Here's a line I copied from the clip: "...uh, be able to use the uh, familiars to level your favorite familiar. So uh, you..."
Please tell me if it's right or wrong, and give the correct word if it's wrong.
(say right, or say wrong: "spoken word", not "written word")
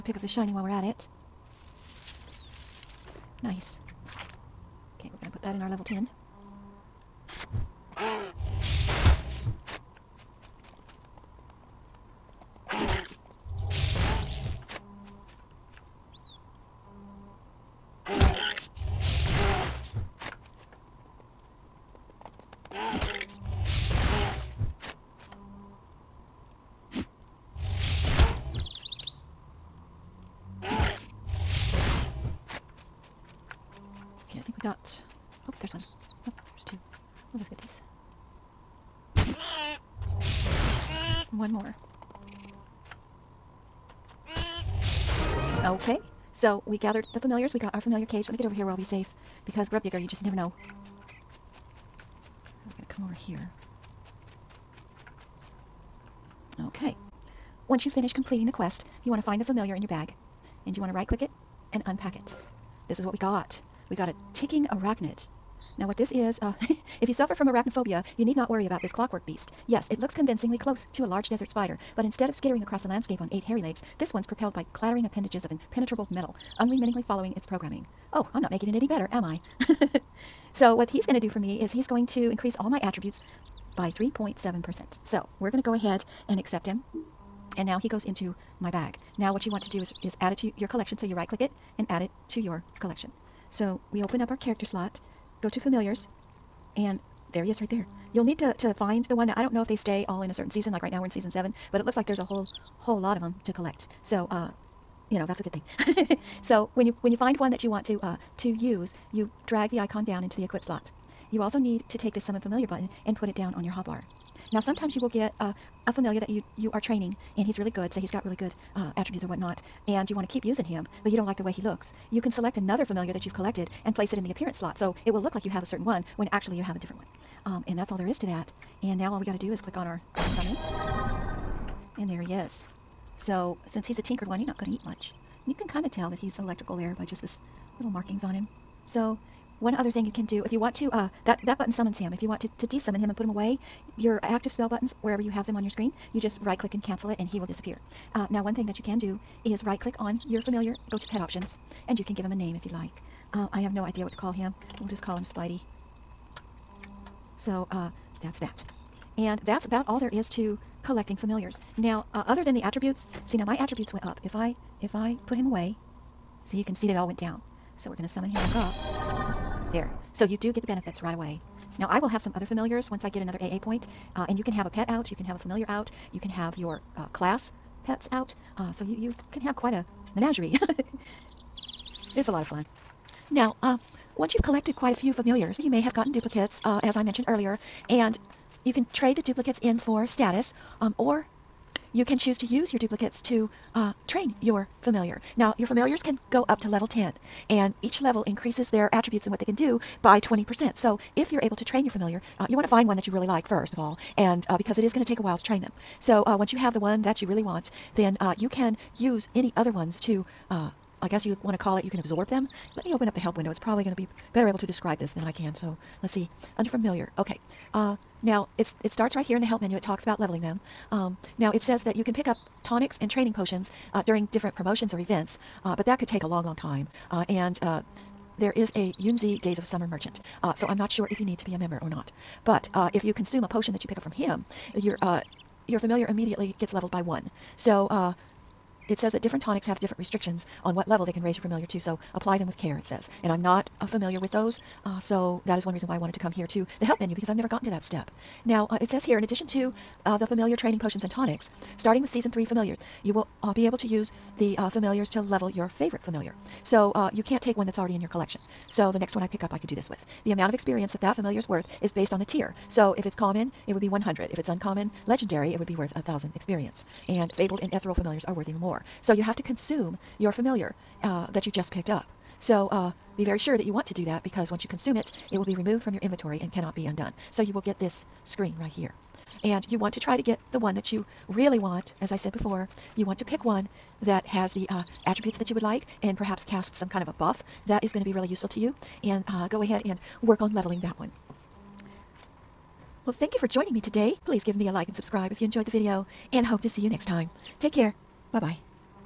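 right.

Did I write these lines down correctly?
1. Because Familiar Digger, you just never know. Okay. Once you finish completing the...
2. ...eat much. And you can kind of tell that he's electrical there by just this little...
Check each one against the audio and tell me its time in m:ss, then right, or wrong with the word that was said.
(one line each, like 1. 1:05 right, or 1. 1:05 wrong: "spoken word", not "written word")
1. 0:49 wrong: "Grub", not "Familiar"
2. 2:14 right.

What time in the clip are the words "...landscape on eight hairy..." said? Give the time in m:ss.
1:12.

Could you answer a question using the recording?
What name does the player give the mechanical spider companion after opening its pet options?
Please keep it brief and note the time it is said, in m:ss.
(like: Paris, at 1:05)
Spidey, at 2:35.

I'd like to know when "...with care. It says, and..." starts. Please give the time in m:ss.
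4:02.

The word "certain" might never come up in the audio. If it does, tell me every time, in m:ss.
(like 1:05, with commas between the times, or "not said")
1:40, 2:05.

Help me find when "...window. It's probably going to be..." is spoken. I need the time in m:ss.
3:33.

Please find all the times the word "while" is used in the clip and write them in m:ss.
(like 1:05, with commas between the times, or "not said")
0:00, 3:25.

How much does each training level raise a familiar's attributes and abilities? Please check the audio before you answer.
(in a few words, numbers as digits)
20%.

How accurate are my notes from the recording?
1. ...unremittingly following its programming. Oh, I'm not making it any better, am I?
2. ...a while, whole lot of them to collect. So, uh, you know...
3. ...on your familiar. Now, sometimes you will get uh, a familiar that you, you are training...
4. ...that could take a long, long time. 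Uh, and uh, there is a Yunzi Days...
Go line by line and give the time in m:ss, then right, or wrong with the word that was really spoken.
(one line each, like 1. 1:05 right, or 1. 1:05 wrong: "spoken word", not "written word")
1. 1:16 right
2. 1:42 wrong: "whole", not "while"
3. 1:53 wrong: "hotbar", not "familiar"
4. 3:45 right.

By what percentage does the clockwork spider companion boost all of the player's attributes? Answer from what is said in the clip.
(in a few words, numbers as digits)
3.7%.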